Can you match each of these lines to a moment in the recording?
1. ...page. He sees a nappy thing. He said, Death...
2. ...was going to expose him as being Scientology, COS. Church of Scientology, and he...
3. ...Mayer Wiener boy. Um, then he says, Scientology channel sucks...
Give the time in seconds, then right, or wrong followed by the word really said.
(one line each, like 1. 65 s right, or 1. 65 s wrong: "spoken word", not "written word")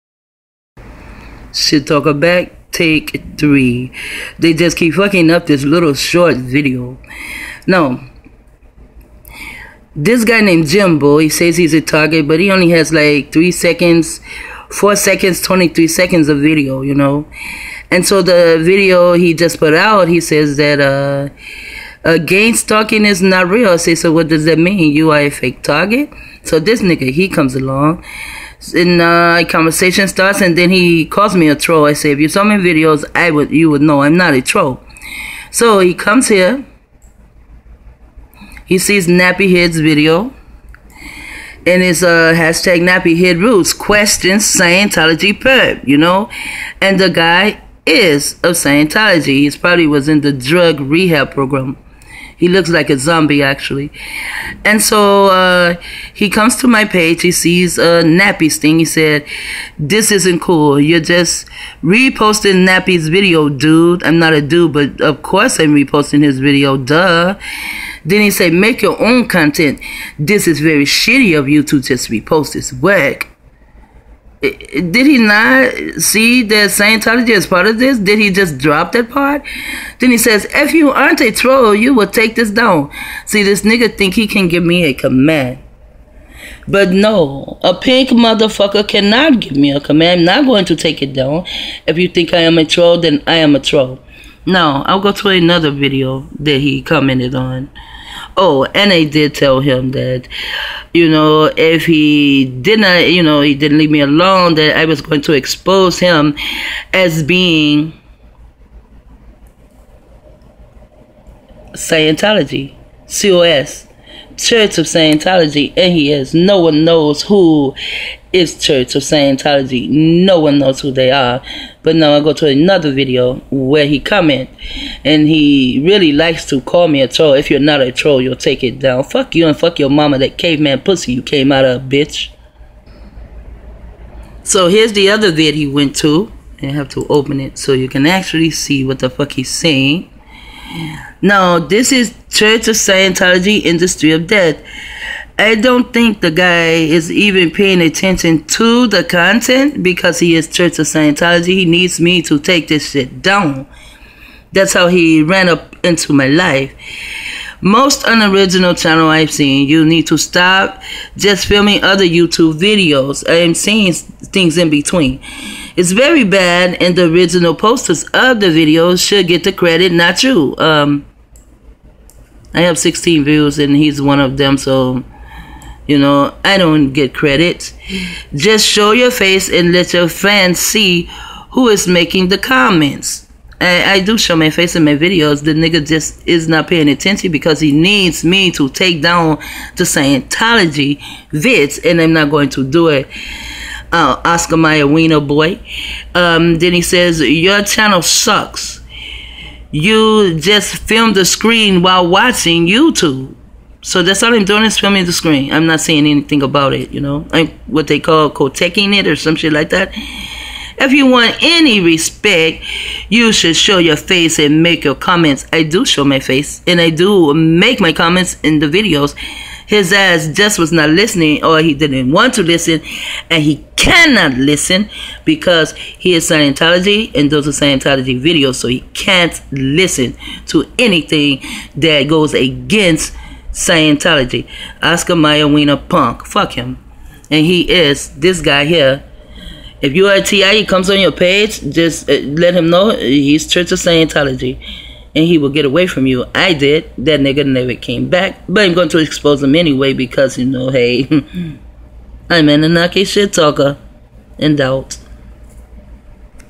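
1. 56 s wrong: "This", not "Death"
2. 104 s right
3. 194 s wrong: "Your", not "Scientology".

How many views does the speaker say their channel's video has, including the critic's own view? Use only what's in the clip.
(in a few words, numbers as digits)
16.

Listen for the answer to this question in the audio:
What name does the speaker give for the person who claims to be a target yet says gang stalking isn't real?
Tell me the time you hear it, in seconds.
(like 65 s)
10 s.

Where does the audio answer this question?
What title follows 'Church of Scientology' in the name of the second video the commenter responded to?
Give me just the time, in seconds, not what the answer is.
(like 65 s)
143 s.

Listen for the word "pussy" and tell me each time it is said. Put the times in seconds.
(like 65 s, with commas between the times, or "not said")
130 s.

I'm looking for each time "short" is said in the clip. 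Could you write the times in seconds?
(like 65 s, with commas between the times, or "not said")
5 s.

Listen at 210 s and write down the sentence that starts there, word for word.
If you want any respect, you should show your face and make your comments.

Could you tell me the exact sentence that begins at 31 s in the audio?
I say, if you saw my videos, I would you would know I'm not a troll.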